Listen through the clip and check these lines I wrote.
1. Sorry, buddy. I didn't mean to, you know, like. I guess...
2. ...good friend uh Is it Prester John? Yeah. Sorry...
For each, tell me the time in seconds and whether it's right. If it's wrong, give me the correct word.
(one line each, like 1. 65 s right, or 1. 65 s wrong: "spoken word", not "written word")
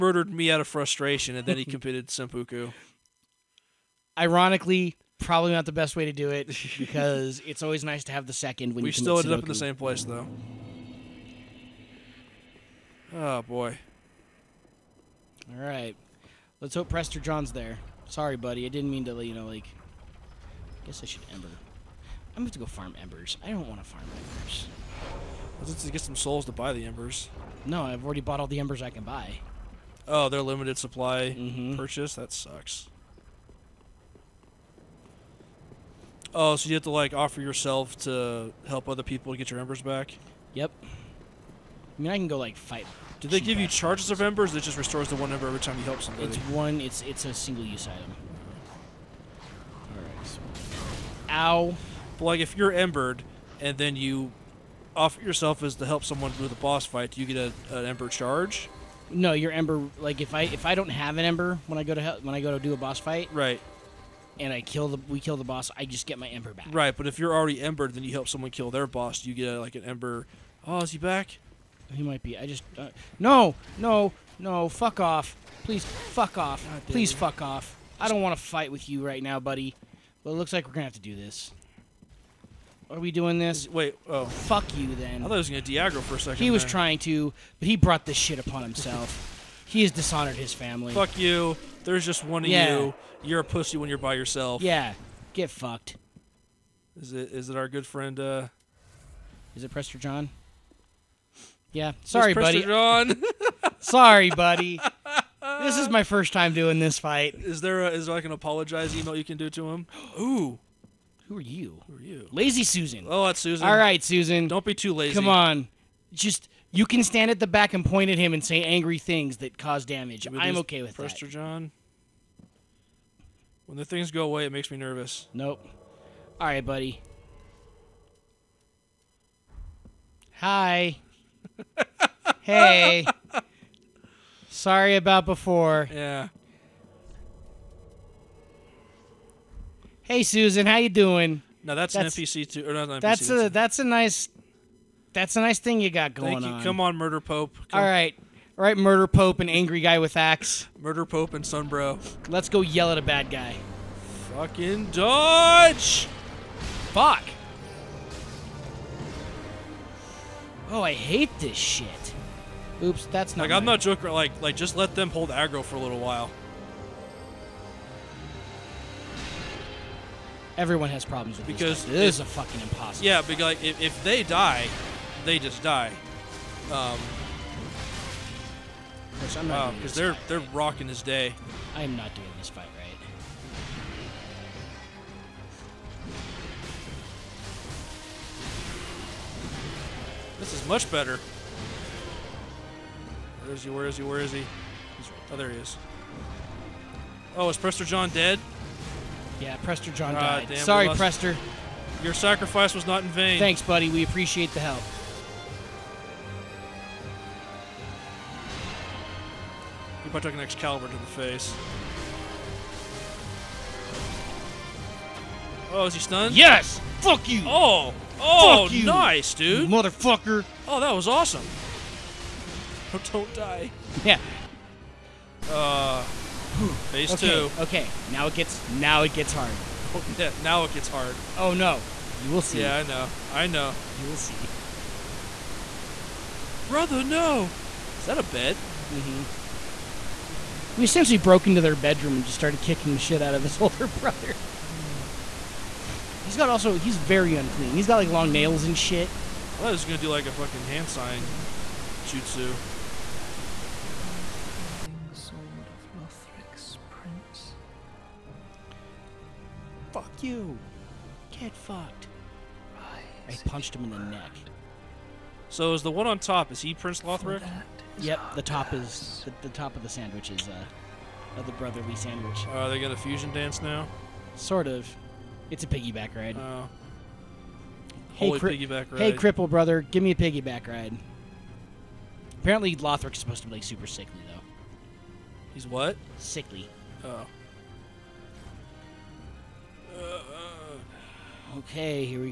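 1. 18 s right
2. 97 s right.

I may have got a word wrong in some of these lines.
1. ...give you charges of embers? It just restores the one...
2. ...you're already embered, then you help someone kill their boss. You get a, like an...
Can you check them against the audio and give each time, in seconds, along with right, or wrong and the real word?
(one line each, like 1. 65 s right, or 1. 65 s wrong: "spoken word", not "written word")
1. 43 s right
2. 67 s right.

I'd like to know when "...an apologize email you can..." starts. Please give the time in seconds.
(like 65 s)
108 s.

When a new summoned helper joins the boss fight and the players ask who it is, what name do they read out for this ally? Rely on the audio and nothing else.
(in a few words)
Lazy Susan.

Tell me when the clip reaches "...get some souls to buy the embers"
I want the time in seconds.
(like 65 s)
25 s.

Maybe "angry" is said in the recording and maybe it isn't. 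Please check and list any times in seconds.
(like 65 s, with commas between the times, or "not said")
118 s, 149 s.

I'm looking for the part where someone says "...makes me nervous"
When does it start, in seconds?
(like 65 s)
124 s.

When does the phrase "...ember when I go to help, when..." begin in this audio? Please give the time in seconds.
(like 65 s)
61 s.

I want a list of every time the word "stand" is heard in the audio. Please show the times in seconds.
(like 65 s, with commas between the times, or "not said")
117 s.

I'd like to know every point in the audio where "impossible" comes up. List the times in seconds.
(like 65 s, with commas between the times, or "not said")
172 s.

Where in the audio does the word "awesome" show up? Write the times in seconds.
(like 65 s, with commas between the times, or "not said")
221 s.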